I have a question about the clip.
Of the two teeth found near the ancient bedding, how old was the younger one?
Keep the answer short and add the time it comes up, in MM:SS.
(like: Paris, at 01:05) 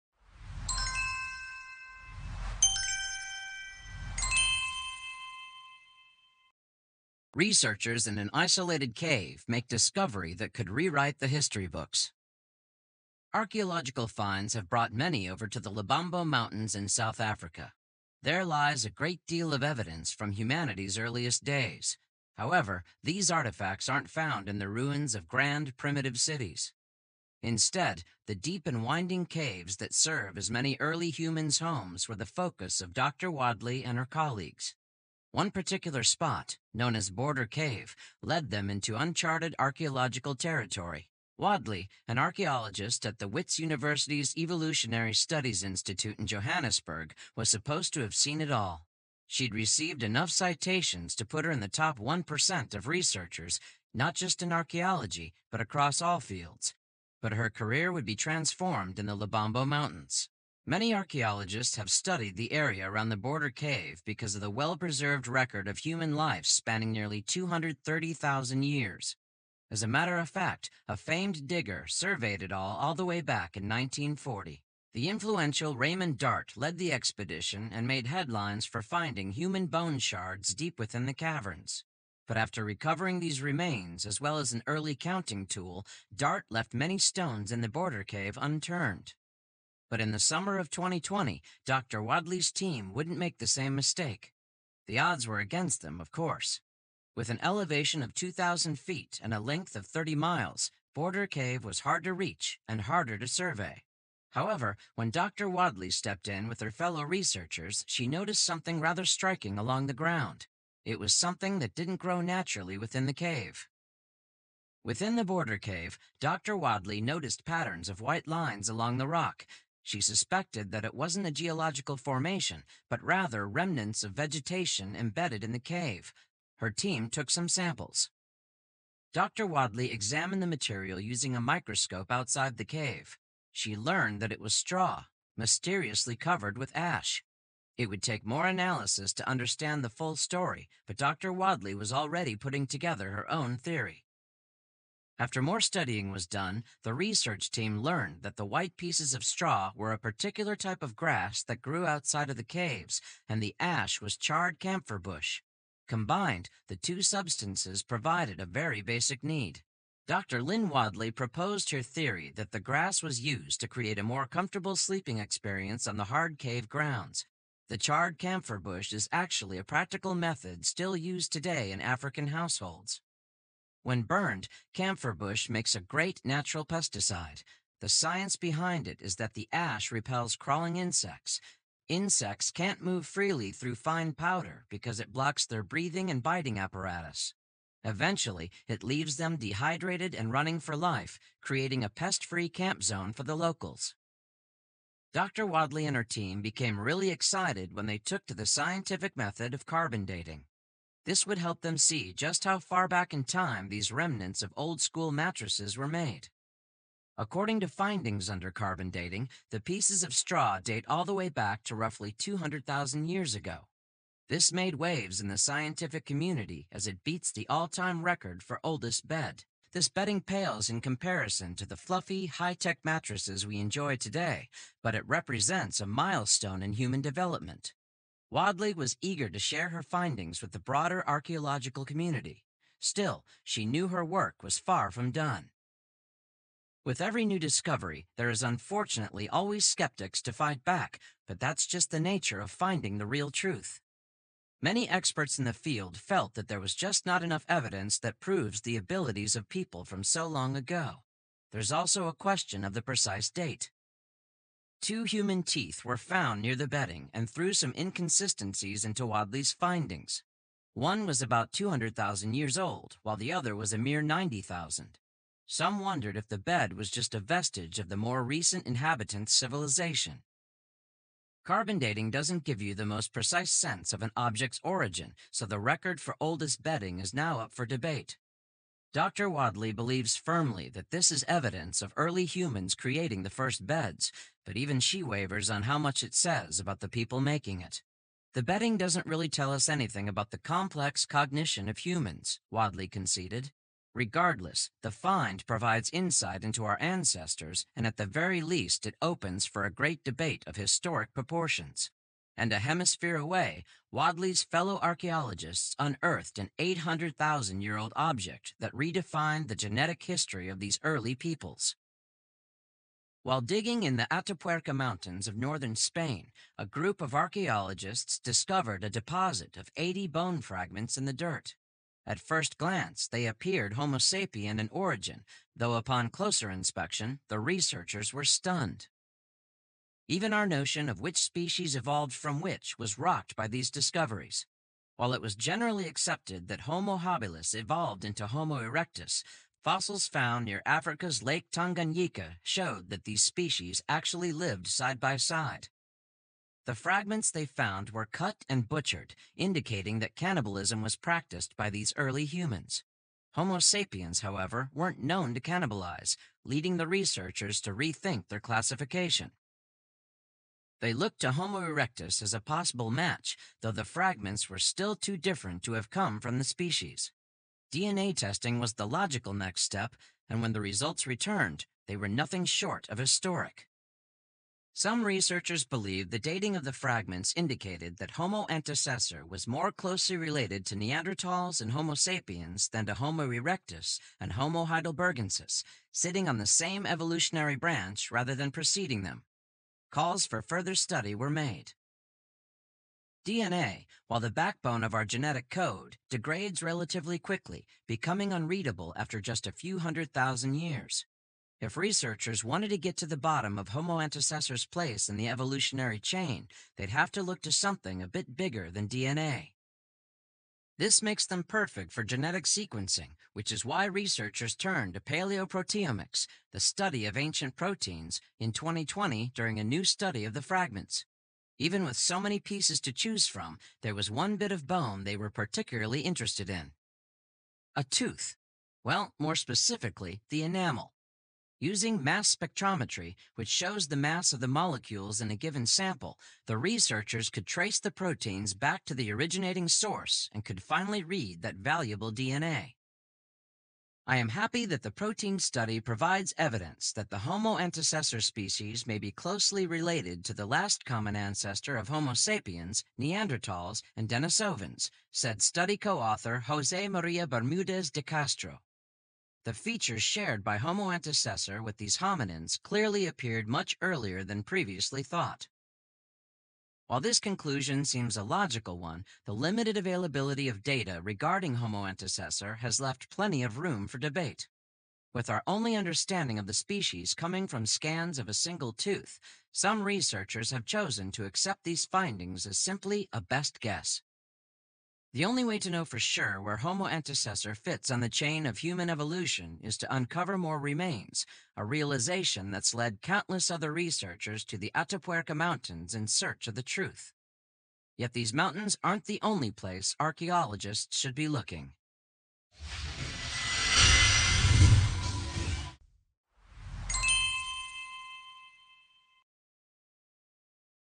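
90,000 years, at 04:24.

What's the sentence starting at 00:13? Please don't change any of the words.
Archaeological finds have brought many over to the Lebombo Mountains in South Africa.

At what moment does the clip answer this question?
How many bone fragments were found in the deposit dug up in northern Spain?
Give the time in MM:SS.
05:19.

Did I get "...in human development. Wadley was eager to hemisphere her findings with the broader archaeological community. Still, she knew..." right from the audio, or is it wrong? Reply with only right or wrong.
wrong.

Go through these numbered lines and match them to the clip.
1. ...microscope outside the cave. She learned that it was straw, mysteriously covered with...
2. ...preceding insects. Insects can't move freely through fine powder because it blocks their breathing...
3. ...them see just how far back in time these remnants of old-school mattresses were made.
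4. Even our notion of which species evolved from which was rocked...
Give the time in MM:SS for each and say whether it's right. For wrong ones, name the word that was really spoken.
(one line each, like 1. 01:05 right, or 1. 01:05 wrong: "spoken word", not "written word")
1. 02:11 right
2. 03:00 wrong: "crawling", not "preceding"
3. 03:21 right
4. 05:30 right.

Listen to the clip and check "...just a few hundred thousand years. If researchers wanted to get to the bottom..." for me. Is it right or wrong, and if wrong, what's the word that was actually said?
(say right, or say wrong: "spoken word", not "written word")
right.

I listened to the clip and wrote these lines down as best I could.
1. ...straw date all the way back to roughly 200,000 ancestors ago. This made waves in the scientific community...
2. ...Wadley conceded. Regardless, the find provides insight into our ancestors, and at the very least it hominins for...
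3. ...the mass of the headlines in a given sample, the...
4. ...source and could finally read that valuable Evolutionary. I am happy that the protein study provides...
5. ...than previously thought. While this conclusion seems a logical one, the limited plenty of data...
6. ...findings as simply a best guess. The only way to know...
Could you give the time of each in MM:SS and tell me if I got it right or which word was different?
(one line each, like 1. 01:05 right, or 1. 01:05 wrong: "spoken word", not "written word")
1. 03:30 wrong: "years", not "ancestors"
2. 04:52 wrong: "opens", not "hominins"
3. 07:13 wrong: "molecules", not "headlines"
4. 07:19 wrong: "DNA", not "Evolutionary"
5. 07:44 wrong: "availability", not "plenty"
6. 08:01 right.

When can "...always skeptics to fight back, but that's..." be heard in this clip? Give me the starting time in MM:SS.
03:59.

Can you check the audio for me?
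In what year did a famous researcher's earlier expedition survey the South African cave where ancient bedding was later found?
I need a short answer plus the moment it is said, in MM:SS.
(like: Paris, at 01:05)
1940, at 01:13.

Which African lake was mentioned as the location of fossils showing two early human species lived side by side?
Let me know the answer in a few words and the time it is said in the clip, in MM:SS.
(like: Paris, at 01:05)
Lake Tanganyika, at 05:41.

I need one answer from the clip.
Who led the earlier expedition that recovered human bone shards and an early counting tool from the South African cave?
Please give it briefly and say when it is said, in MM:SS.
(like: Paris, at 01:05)
Raymond Dart, at 01:15.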